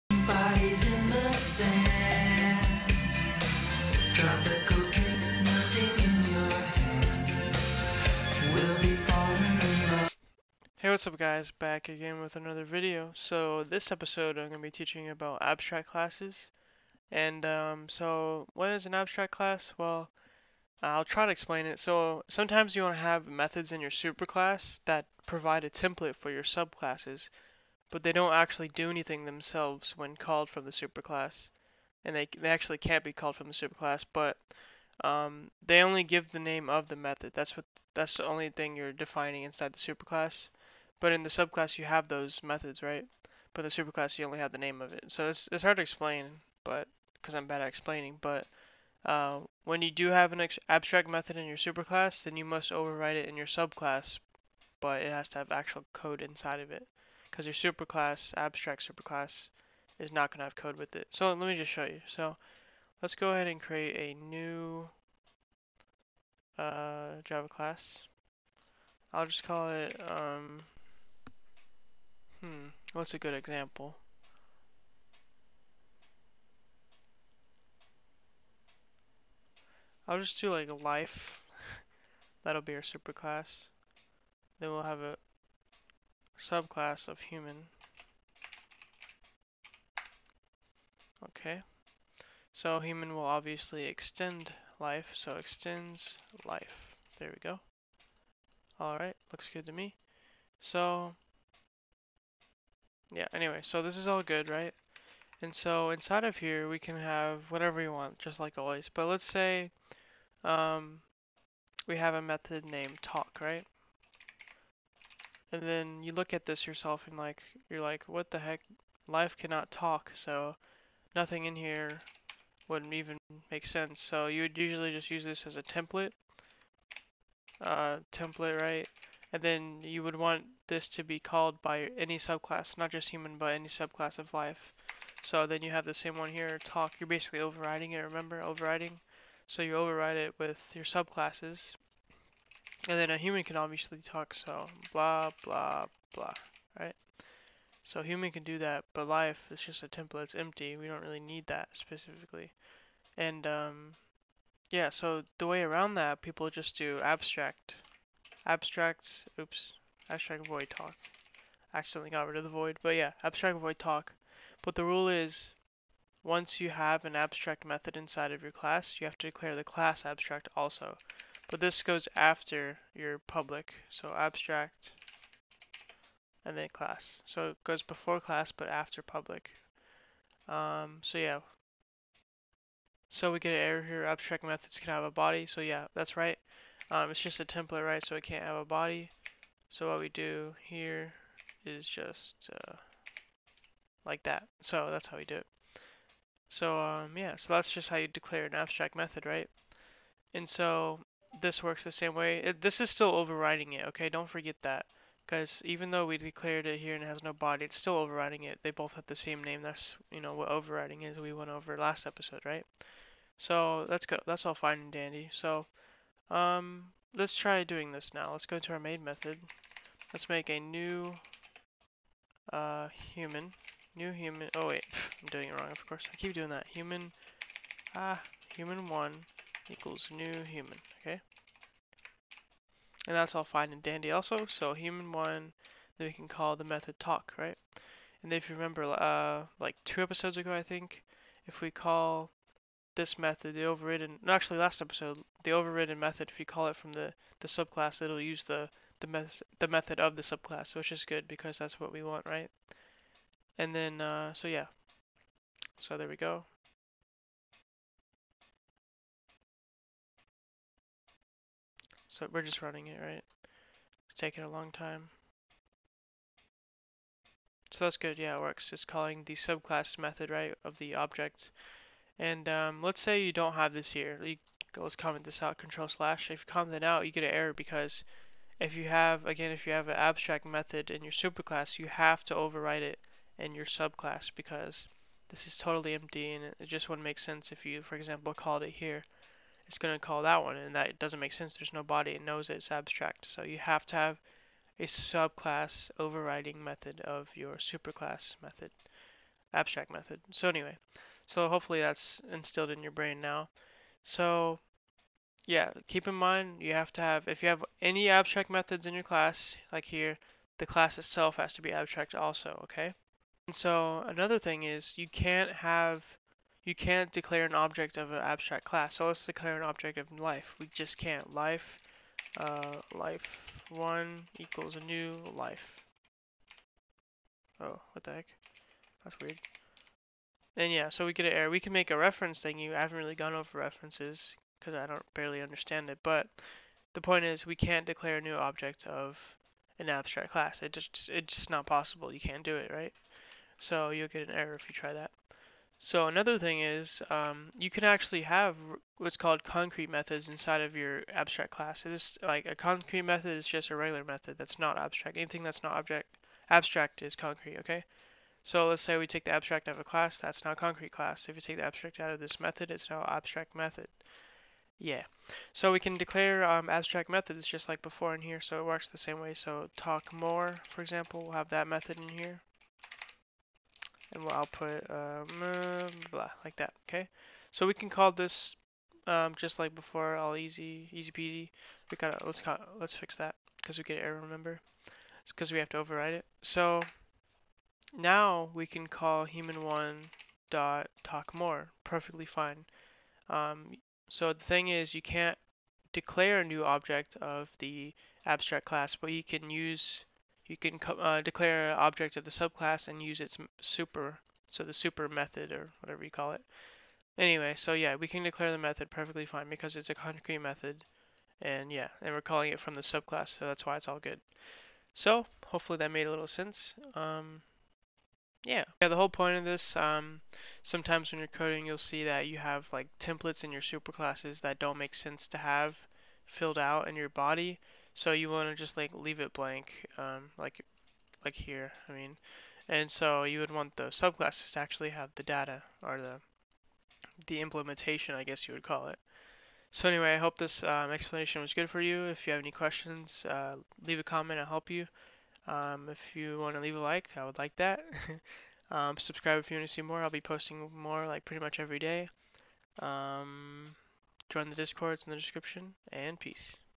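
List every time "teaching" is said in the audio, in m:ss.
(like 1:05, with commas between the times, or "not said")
0:14.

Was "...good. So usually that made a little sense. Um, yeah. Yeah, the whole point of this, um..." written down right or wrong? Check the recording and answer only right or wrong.
wrong.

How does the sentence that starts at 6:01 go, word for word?
If we take the abstract out of this method, it's now abstract method.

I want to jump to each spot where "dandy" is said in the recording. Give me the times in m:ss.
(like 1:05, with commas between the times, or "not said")
3:34, 3:53.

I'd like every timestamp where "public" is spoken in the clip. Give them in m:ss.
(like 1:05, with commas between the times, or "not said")
2:53, 2:59.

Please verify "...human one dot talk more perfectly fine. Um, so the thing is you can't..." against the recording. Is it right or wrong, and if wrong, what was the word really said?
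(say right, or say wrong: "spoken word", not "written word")
right.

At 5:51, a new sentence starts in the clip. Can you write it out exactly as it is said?
It's like a concrete method is just a regular method that's not abstract.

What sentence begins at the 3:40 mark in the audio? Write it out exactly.
Let's make a new uh, human.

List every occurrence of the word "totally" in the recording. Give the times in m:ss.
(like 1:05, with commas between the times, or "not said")
4:45.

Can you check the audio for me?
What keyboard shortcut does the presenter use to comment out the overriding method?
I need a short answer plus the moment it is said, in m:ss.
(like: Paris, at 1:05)
control slash, at 4:35.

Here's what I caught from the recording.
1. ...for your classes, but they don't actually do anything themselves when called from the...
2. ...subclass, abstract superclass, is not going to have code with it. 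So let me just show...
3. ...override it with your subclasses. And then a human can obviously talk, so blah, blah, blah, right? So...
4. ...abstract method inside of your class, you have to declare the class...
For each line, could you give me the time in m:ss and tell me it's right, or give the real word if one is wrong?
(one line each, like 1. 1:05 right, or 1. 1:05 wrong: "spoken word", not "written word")
1. 0:26 wrong: "subclasses", not "classes"
2. 0:57 wrong: "superclass", not "subclass"
3. 2:19 right
4. 2:47 right.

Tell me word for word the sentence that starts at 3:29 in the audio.
That's, you know, what overriding is.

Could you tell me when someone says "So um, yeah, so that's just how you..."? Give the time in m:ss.
3:16.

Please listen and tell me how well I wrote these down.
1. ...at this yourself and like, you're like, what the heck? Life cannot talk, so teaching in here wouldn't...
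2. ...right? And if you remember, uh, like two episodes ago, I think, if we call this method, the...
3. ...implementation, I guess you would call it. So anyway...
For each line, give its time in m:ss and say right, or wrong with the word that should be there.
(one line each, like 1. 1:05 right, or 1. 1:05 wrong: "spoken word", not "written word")
1. 1:56 wrong: "nothing", not "teaching"
2. 3:57 right
3. 7:17 right.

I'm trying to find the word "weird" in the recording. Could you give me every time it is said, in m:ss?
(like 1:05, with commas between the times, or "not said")
5:29.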